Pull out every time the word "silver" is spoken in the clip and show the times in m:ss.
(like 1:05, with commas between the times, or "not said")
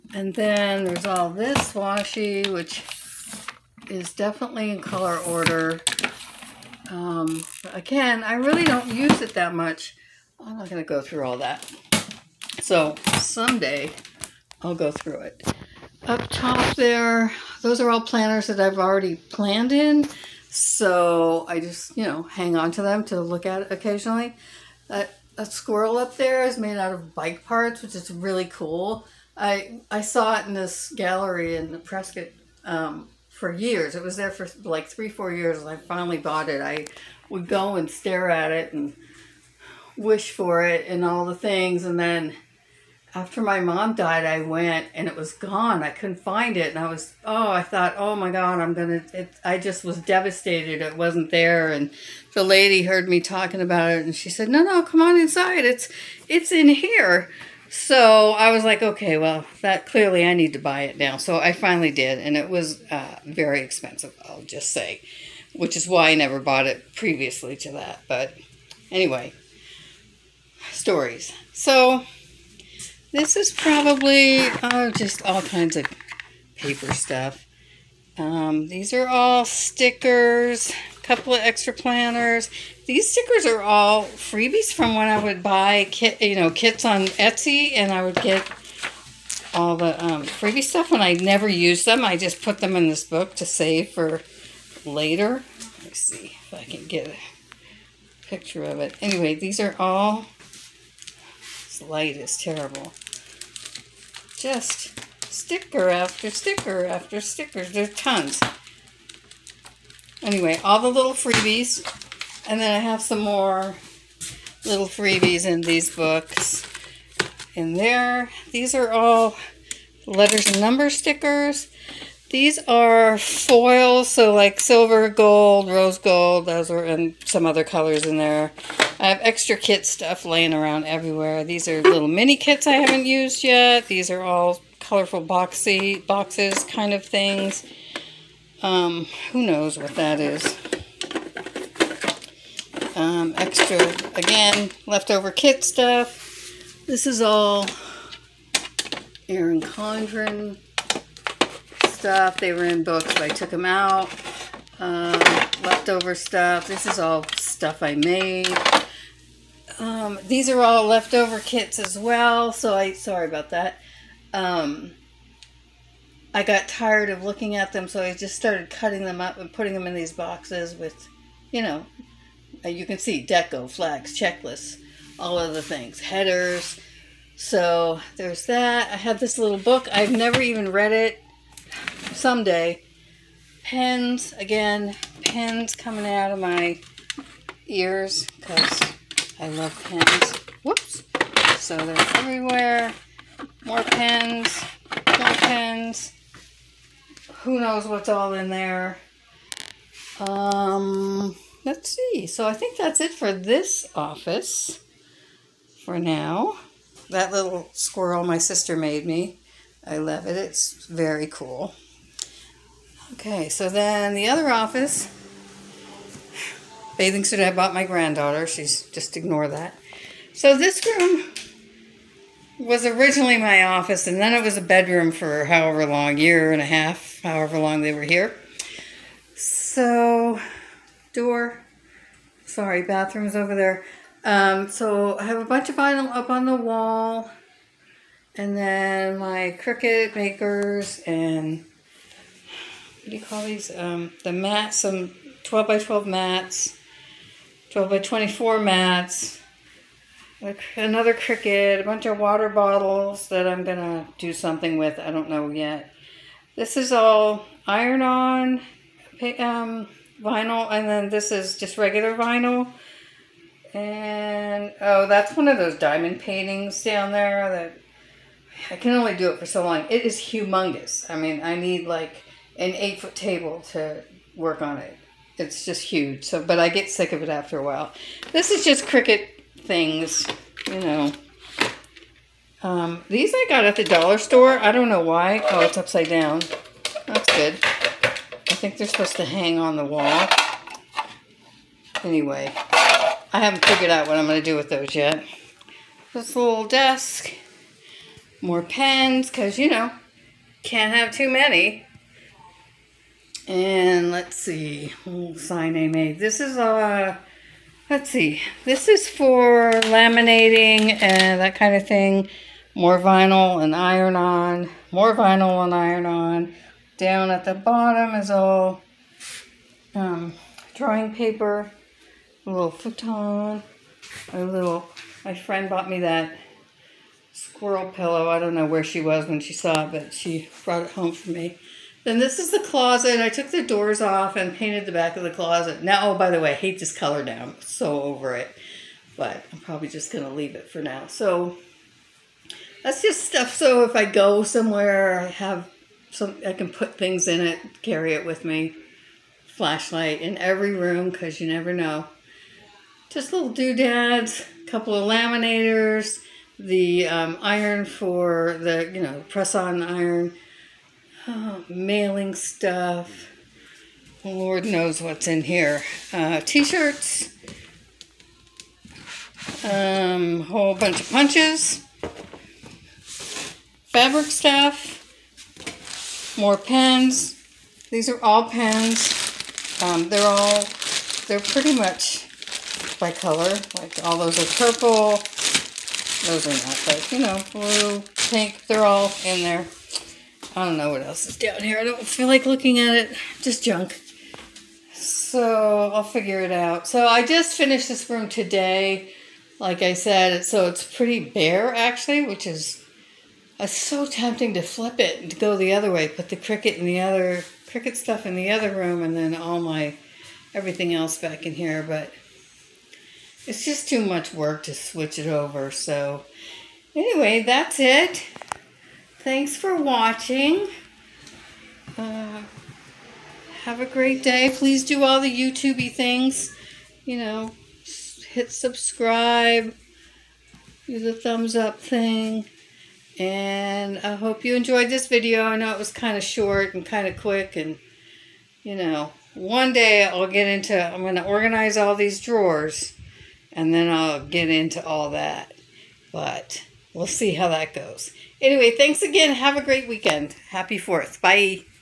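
2:04.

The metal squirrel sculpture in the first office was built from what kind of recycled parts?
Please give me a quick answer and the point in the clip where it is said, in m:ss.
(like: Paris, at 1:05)
bike parts, at 0:27.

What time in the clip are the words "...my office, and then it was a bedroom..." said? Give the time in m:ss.
3:43.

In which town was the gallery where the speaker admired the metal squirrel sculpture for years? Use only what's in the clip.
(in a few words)
Prescott.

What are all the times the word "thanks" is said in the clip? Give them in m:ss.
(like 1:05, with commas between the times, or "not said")
6:59, 7:28.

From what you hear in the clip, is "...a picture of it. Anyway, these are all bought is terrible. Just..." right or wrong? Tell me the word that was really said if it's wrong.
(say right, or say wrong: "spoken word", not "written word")
wrong: "light", not "bought".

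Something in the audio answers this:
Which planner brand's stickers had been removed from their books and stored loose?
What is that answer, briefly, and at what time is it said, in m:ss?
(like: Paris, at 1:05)
Erin Condren, at 2:29.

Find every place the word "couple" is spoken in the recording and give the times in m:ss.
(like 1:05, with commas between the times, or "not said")
1:21, 5:54.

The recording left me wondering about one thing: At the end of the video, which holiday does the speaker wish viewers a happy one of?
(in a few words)
4th of July.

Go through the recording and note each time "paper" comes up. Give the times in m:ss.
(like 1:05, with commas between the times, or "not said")
1:16, 5:21.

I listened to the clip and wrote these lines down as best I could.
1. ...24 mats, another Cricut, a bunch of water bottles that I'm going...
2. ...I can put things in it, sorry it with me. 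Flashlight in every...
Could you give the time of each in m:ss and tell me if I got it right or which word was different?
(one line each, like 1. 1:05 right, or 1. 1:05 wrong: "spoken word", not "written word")
1. 4:07 right
2. 5:46 wrong: "carry", not "sorry".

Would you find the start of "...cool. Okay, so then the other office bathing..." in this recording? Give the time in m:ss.
3:31.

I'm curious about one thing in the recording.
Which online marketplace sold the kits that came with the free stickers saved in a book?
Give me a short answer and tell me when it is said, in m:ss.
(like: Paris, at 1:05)
Etsy, at 1:27.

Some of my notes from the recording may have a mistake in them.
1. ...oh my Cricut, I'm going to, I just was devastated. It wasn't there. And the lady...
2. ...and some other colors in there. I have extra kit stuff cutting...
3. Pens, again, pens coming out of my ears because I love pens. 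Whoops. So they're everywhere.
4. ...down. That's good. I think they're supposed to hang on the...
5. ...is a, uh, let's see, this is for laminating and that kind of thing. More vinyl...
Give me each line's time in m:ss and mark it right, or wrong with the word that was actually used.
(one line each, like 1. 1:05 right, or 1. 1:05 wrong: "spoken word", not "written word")
1. 0:47 wrong: "God", not "Cricut"
2. 2:06 wrong: "laying", not "cutting"
3. 3:03 right
4. 4:46 right
5. 5:06 right.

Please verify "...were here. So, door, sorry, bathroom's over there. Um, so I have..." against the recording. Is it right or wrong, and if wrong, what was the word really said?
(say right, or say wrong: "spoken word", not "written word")
right.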